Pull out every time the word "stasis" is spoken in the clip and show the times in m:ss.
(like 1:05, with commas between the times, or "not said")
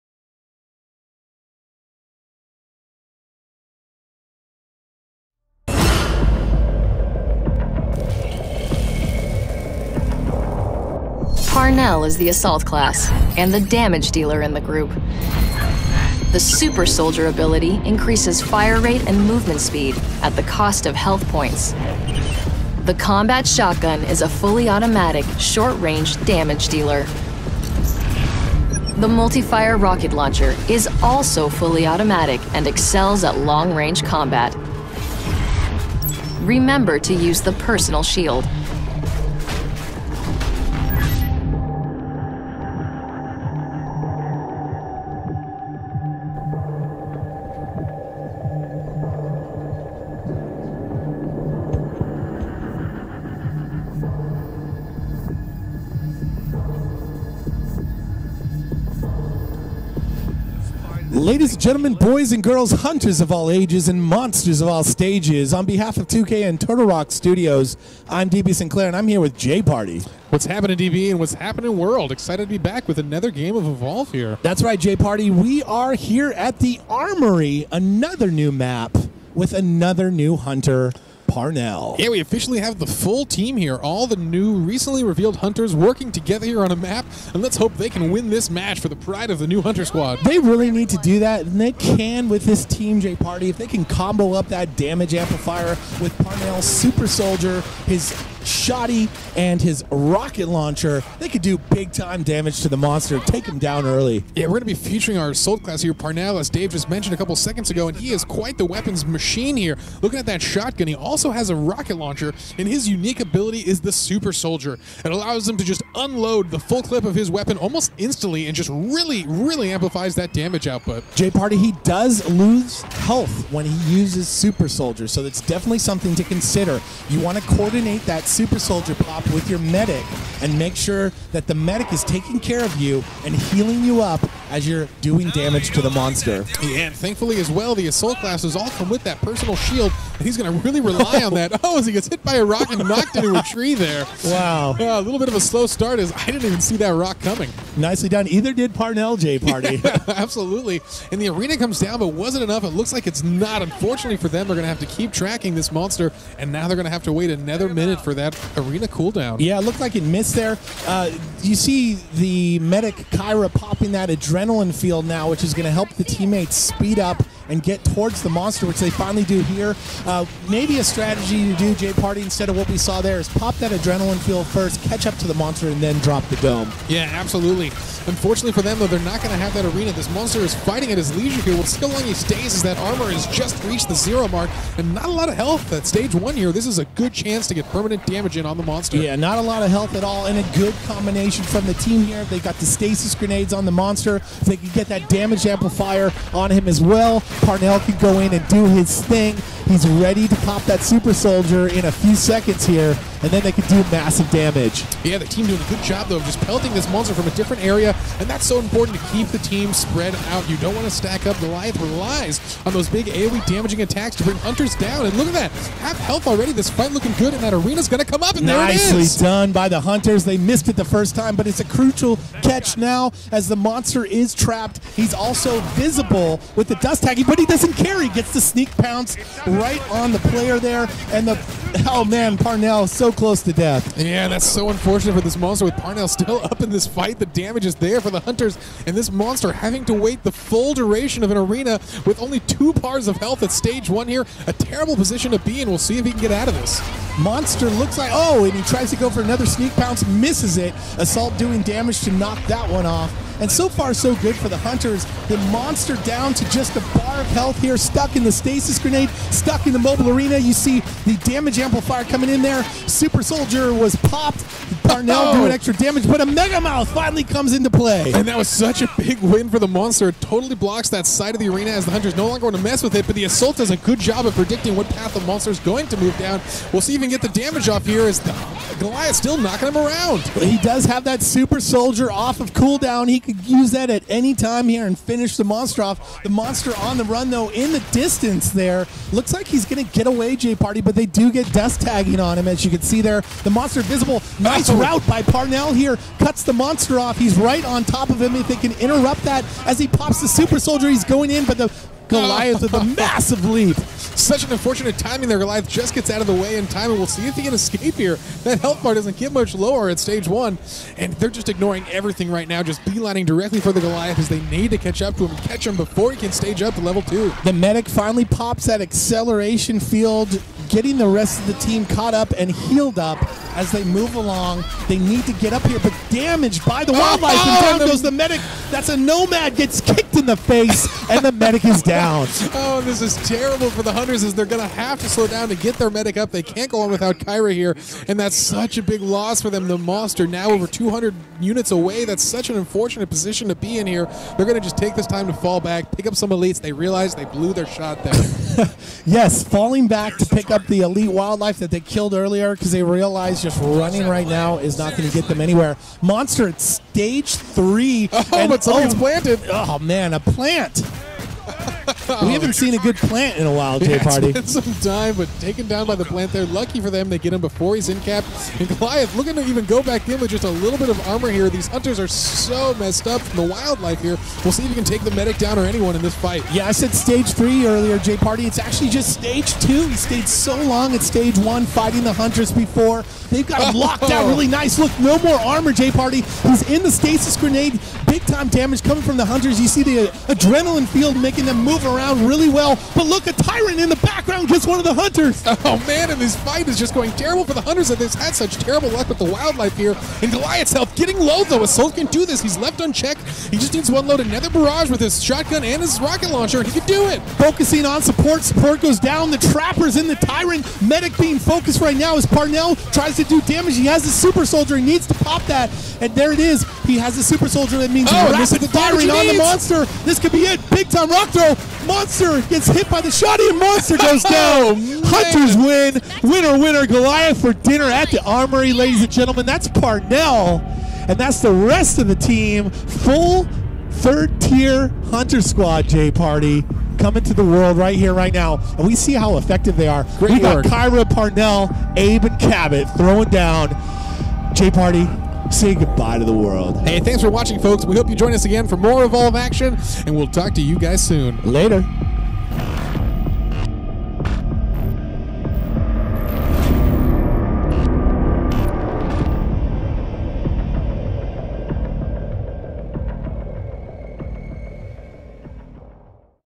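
3:12, 4:18, 6:26.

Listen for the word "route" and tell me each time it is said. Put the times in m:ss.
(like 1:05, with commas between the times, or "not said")
4:54.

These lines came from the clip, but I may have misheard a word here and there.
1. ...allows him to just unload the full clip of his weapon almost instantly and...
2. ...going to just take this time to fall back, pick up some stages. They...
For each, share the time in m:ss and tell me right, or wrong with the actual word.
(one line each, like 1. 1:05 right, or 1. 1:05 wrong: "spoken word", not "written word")
1. 1:55 right
2. 5:44 wrong: "elites", not "stages".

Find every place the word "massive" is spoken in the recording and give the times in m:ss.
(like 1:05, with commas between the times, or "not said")
3:23, 5:02.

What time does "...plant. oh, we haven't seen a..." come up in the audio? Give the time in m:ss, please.
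6:00.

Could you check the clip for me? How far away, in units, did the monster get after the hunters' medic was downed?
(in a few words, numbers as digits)
over 200 units.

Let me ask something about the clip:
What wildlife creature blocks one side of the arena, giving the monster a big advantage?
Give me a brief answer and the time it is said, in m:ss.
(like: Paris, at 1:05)
Mega Mouth, at 4:26.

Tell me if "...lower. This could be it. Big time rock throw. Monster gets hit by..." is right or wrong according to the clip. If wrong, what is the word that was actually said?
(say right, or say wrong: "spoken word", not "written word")
wrong: "monster", not "lower".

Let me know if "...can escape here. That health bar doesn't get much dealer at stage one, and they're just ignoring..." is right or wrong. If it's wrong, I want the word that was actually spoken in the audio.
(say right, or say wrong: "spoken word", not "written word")
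wrong: "lower", not "dealer".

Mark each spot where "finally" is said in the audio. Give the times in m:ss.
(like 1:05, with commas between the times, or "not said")
2:48, 4:26, 5:17.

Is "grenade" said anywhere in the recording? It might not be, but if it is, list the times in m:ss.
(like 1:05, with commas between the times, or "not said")
3:13, 4:18, 6:27.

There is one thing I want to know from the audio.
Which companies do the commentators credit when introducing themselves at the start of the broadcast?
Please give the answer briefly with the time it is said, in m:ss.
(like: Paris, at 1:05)
2K and Turtle Rock Studios, at 1:06.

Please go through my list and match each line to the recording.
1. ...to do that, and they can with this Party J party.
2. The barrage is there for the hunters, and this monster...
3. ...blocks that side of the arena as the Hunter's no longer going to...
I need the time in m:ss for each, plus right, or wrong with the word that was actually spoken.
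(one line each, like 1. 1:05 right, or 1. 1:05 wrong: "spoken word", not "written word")
1. 1:30 wrong: "Team", not "Party"
2. 3:57 wrong: "damage", not "barrage"
3. 4:30 right.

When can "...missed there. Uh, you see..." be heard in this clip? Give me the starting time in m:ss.
2:40.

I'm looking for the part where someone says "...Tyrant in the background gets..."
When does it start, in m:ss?
6:33.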